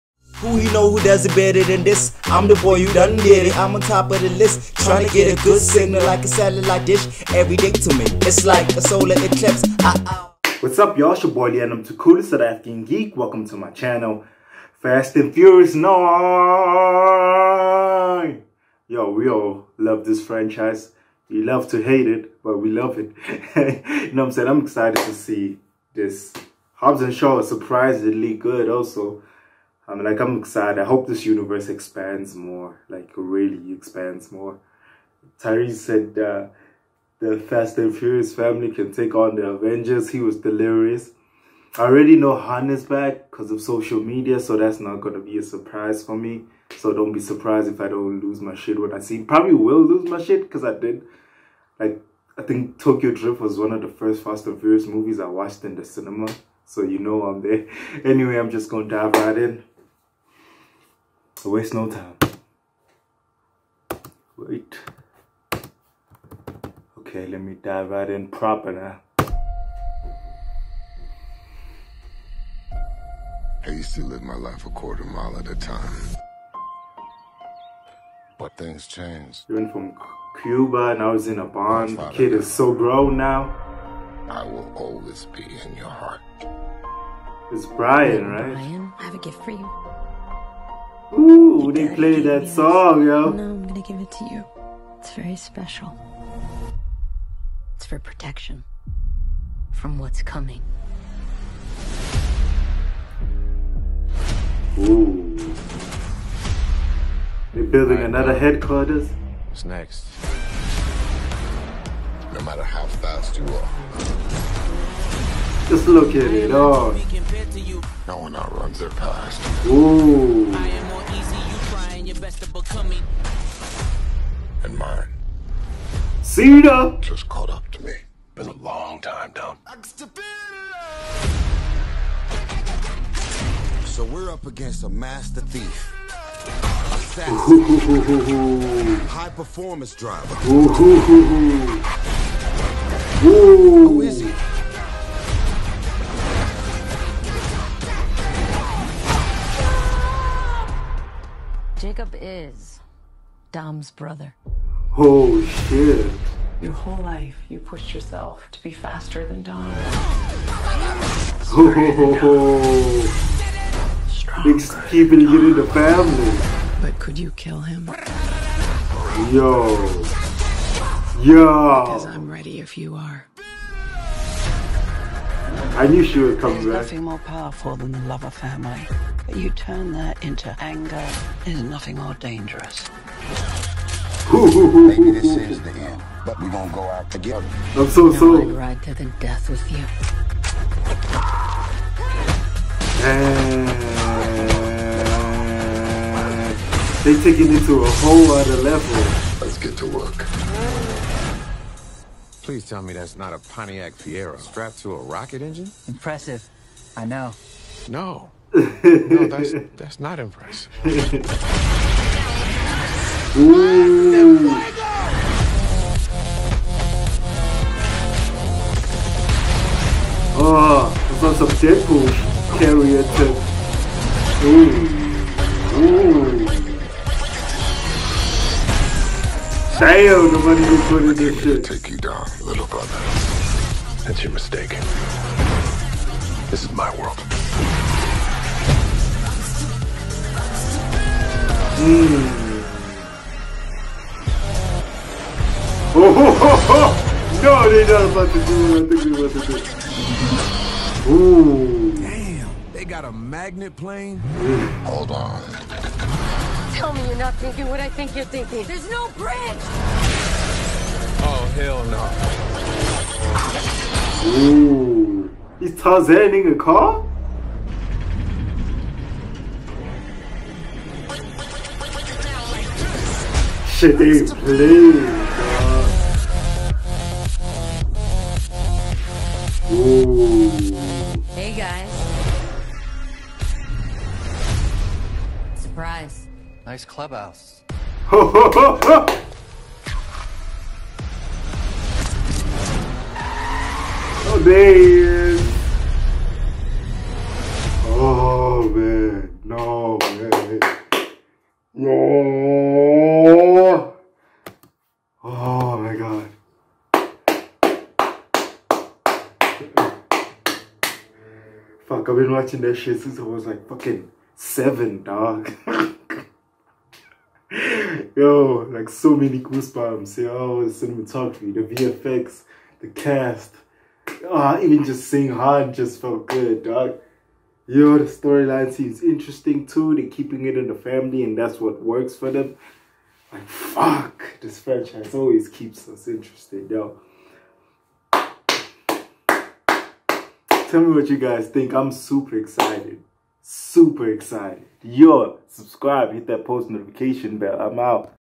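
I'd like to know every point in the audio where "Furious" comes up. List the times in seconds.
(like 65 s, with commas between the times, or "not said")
15 s, 37 s, 54 s.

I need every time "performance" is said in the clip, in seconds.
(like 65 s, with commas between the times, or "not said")
139 s.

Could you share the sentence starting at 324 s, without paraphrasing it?
Oh, even just seeing Han just felt good, dog.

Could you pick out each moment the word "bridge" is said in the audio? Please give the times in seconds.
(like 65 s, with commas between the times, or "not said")
259 s.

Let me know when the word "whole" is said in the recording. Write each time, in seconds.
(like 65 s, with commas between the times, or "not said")
156 s, 197 s.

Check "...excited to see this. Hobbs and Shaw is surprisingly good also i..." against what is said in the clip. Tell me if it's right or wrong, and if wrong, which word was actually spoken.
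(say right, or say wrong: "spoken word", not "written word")
right.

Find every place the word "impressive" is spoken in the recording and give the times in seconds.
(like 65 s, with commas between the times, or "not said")
205 s, 210 s.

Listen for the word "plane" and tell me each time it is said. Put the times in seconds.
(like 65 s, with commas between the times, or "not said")
253 s.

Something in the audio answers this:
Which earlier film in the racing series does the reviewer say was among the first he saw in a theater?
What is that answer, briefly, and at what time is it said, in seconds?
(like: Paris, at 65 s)
Tokyo Drift, at 52 s.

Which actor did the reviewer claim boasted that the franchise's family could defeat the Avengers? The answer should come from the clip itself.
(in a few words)
Tyrese.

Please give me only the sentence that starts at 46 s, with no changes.
So don't be surprised if I don't lose my shit when I see.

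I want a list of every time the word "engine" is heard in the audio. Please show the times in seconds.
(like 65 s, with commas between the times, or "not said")
205 s.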